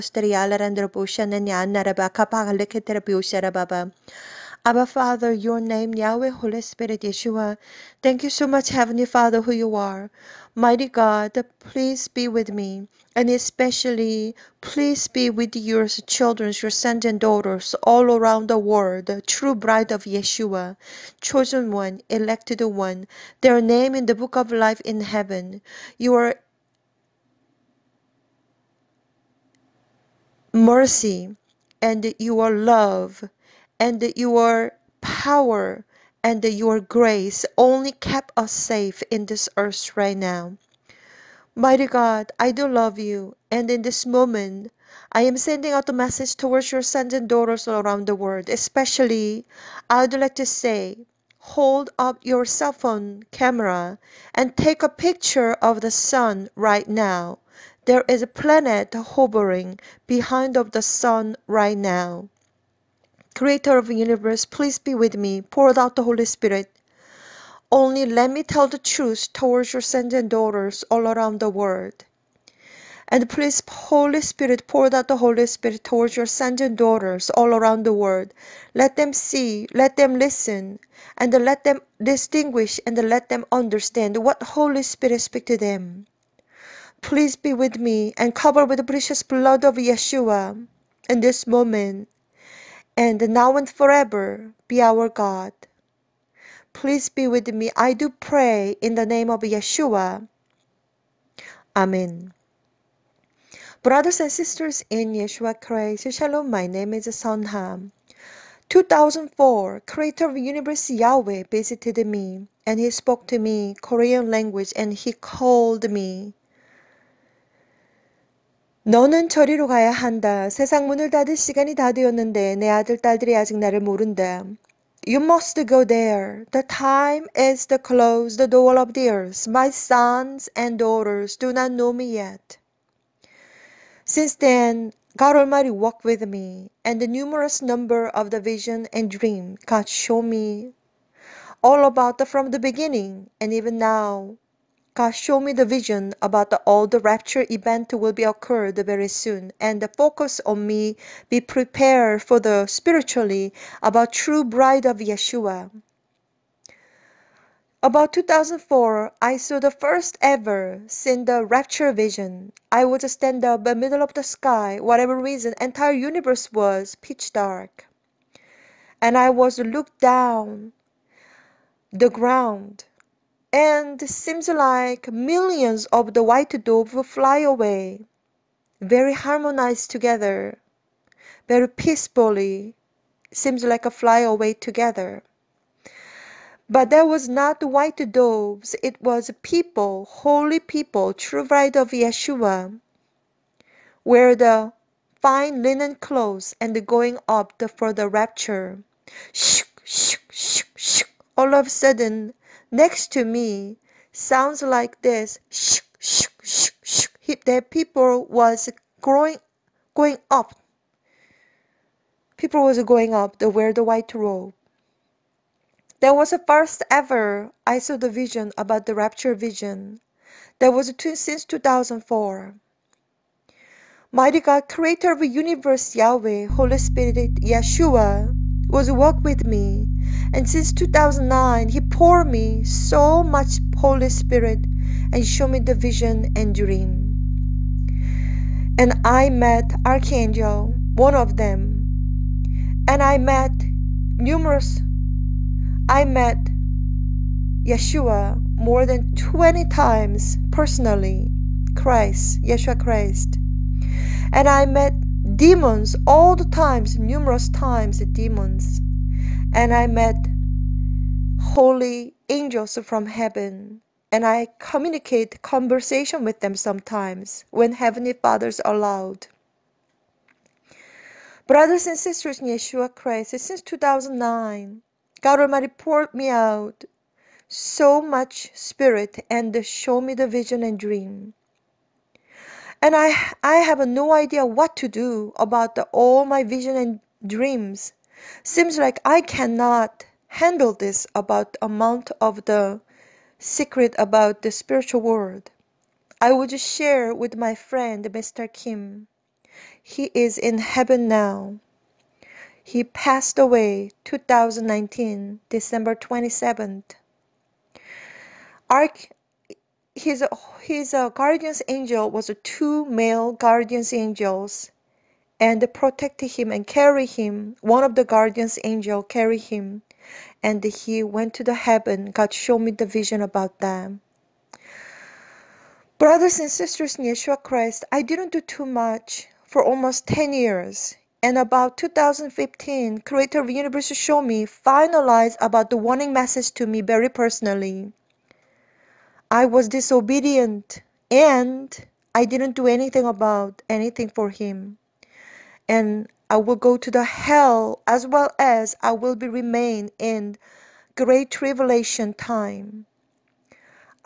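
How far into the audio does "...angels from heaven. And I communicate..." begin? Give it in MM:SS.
04:22.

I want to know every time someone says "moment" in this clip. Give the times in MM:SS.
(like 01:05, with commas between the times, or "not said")
00:44, 01:31.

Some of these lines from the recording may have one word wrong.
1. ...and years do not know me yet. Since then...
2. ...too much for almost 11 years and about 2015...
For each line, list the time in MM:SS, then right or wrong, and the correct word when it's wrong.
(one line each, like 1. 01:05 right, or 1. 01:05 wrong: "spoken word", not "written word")
1. 02:10 wrong: "daughters", not "years"
2. 05:28 wrong: "10", not "11".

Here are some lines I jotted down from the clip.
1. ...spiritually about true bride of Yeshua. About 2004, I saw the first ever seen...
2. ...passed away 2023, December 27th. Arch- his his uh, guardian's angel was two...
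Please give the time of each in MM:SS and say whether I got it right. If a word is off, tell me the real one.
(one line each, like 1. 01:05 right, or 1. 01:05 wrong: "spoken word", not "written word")
1. 02:32 right
2. 05:02 wrong: "2019", not "2023".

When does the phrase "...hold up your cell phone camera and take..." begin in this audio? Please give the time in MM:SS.
00:51.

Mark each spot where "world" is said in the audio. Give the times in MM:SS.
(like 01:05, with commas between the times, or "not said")
00:18, 00:48, 01:11, 01:17, 04:55.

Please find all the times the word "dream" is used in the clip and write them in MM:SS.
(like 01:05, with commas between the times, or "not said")
02:19, 03:56, 04:40, 04:47.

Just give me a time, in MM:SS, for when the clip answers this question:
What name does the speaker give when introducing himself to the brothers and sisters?
01:47.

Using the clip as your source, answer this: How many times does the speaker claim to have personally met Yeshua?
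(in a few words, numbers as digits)
more than 20 times.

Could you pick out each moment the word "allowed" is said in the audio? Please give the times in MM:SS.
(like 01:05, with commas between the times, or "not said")
04:28.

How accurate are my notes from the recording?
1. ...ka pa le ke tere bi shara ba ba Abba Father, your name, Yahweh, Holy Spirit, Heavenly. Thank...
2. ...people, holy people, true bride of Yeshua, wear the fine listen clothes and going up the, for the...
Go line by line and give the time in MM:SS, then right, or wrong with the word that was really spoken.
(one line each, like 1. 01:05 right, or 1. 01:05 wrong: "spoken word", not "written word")
1. 00:02 wrong: "Yeshua", not "Heavenly"
2. 03:09 wrong: "linen", not "listen".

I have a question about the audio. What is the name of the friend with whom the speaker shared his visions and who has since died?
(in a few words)
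Mr. Kim.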